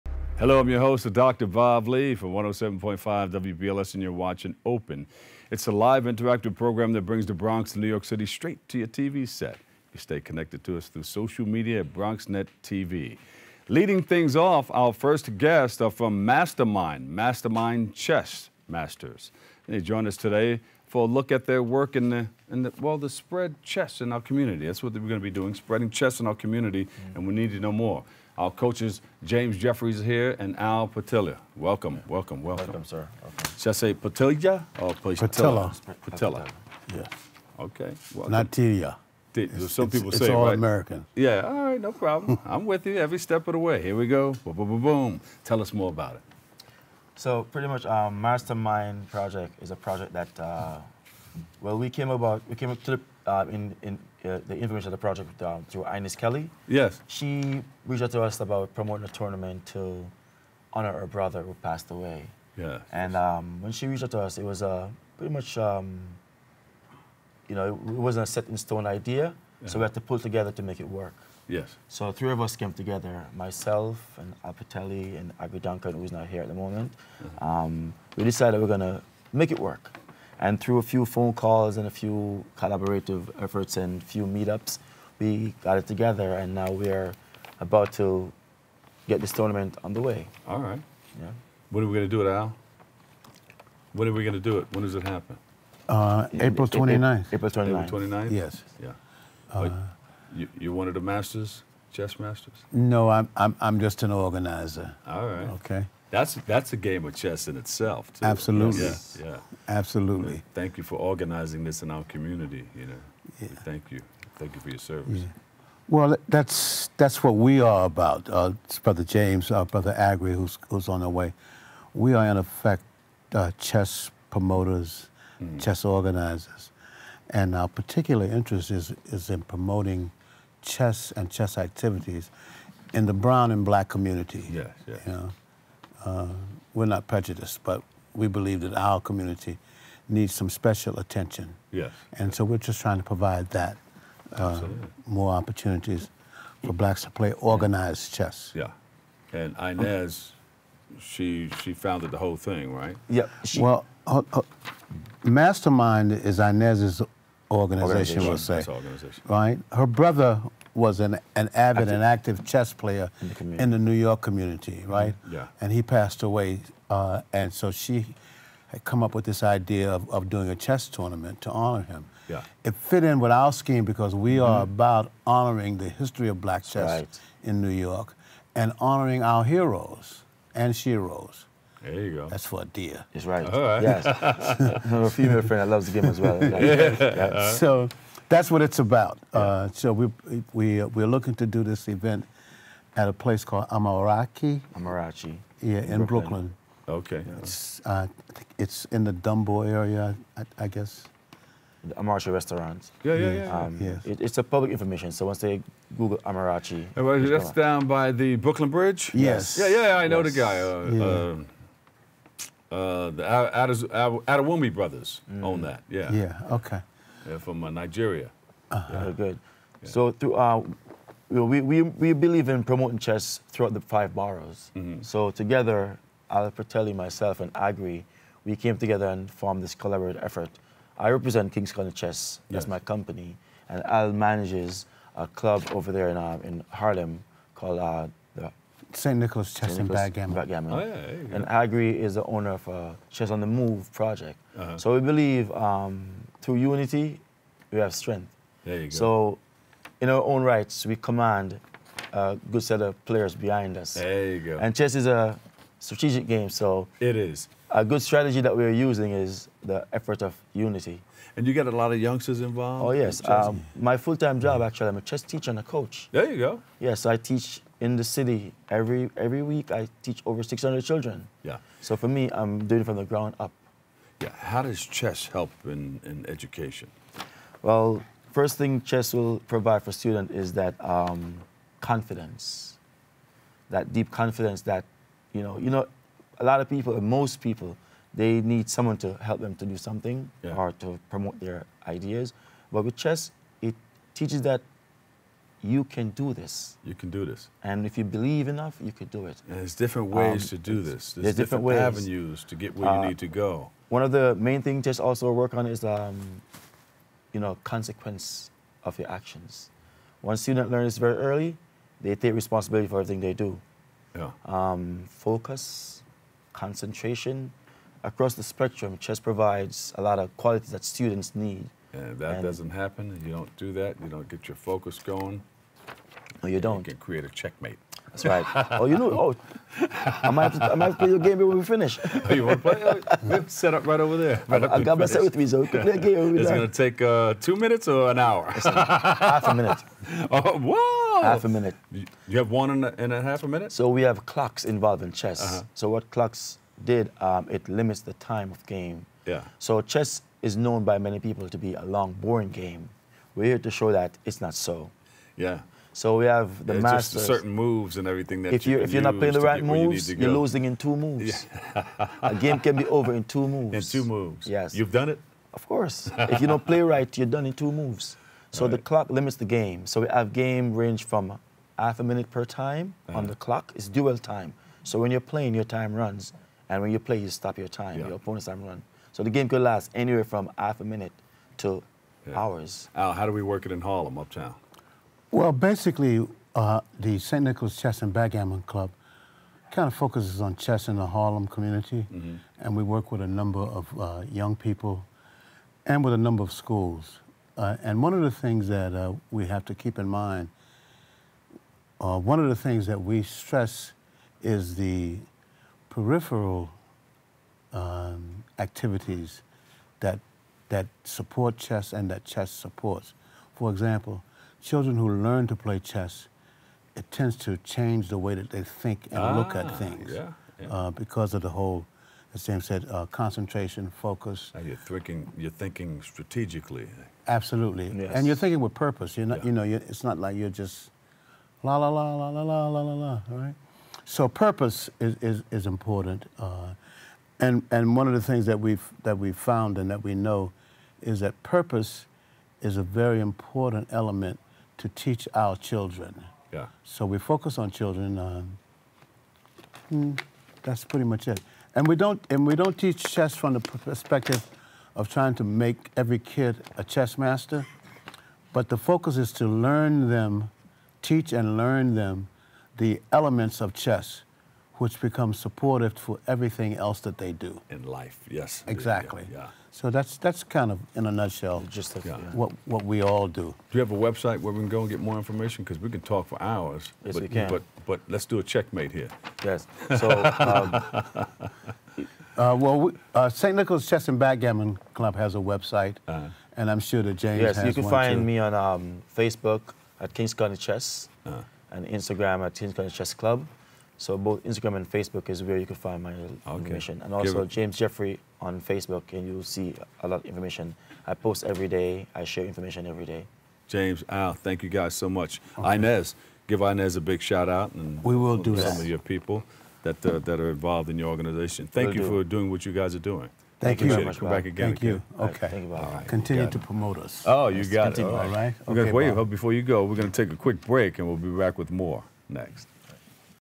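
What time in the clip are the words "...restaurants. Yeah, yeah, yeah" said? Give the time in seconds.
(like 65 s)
202 s.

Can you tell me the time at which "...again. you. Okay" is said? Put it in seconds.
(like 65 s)
514 s.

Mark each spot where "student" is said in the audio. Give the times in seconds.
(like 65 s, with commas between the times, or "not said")
279 s, 310 s, 320 s.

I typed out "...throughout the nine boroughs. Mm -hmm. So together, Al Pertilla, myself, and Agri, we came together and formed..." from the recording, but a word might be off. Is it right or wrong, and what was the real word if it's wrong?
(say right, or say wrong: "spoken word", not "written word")
wrong: "five", not "nine".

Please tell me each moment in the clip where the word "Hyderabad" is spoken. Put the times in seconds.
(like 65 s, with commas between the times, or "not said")
not said.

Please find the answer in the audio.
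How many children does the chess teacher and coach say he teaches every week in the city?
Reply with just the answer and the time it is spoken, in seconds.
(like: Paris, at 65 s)
600, at 270 s.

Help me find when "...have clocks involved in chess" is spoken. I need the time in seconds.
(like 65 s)
344 s.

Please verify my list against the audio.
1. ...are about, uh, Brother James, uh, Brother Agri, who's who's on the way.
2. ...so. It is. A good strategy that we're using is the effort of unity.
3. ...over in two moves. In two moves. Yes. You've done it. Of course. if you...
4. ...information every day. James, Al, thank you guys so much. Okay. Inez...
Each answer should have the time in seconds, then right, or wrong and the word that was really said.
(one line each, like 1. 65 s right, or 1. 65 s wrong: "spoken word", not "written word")
1. 117 s right
2. 256 s right
3. 362 s right
4. 502 s right.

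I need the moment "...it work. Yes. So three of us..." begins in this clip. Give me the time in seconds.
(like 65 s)
70 s.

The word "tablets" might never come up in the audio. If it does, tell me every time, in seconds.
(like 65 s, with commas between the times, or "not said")
not said.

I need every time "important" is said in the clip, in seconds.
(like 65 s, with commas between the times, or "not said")
435 s, 443 s.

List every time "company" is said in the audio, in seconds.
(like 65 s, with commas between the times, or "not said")
232 s.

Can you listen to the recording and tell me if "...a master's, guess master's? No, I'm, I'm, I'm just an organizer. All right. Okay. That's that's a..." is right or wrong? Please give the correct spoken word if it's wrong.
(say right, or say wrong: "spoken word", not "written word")
wrong: "chess", not "guess".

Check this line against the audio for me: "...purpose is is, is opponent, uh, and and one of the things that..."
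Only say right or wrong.
wrong.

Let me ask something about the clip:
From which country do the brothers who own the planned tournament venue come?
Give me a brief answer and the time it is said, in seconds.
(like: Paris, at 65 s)
Nigeria, at 217 s.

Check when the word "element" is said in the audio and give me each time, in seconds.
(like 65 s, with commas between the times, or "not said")
443 s, 463 s.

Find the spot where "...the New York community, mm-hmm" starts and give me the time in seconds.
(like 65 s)
163 s.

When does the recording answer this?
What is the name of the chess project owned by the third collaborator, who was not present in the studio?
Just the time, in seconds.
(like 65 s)
243 s.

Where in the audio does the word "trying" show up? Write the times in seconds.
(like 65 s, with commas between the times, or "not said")
142 s, 455 s.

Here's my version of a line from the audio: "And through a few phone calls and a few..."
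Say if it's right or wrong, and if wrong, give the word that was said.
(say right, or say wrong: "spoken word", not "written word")
right.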